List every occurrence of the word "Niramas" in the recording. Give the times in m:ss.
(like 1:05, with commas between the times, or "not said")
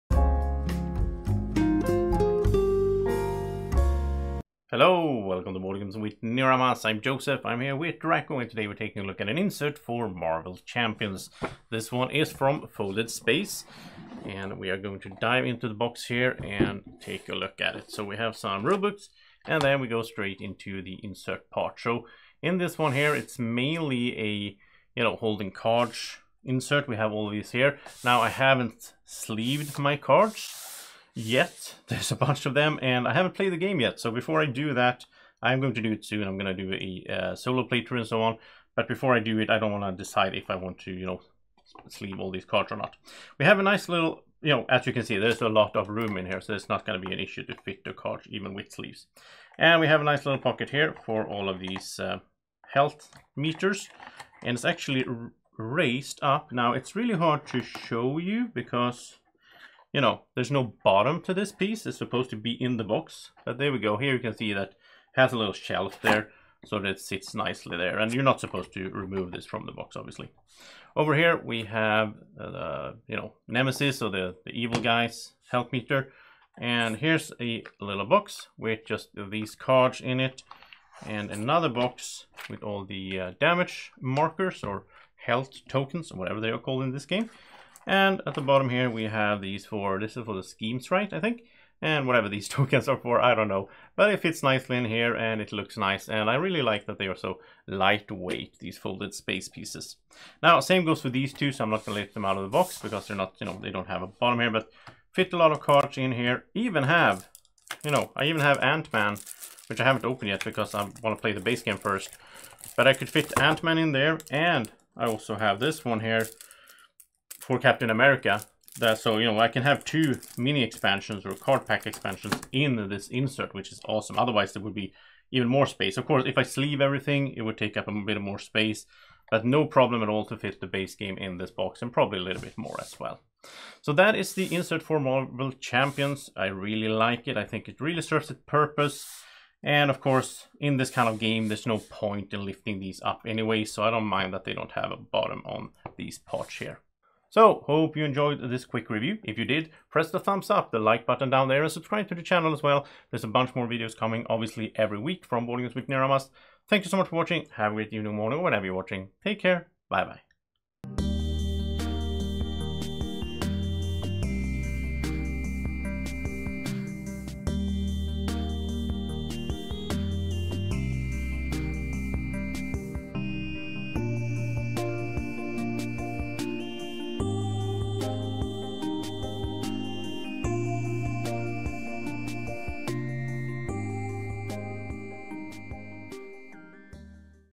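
0:06, 2:35.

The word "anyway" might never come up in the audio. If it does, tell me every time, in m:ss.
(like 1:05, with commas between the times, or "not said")
2:23.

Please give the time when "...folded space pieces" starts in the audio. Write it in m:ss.
1:38.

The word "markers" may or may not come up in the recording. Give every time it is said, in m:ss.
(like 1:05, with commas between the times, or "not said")
1:23.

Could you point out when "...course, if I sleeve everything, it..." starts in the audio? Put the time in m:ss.
2:06.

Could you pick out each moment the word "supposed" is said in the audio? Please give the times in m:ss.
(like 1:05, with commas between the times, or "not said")
1:01, 1:08.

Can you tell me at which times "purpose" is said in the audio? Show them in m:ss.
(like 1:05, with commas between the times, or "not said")
2:18.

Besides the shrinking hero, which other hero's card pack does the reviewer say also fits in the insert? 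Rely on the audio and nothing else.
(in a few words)
Captain America.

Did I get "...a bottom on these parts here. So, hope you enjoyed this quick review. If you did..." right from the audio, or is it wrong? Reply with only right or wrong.
right.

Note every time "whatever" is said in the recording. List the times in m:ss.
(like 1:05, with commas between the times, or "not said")
1:26, 1:32.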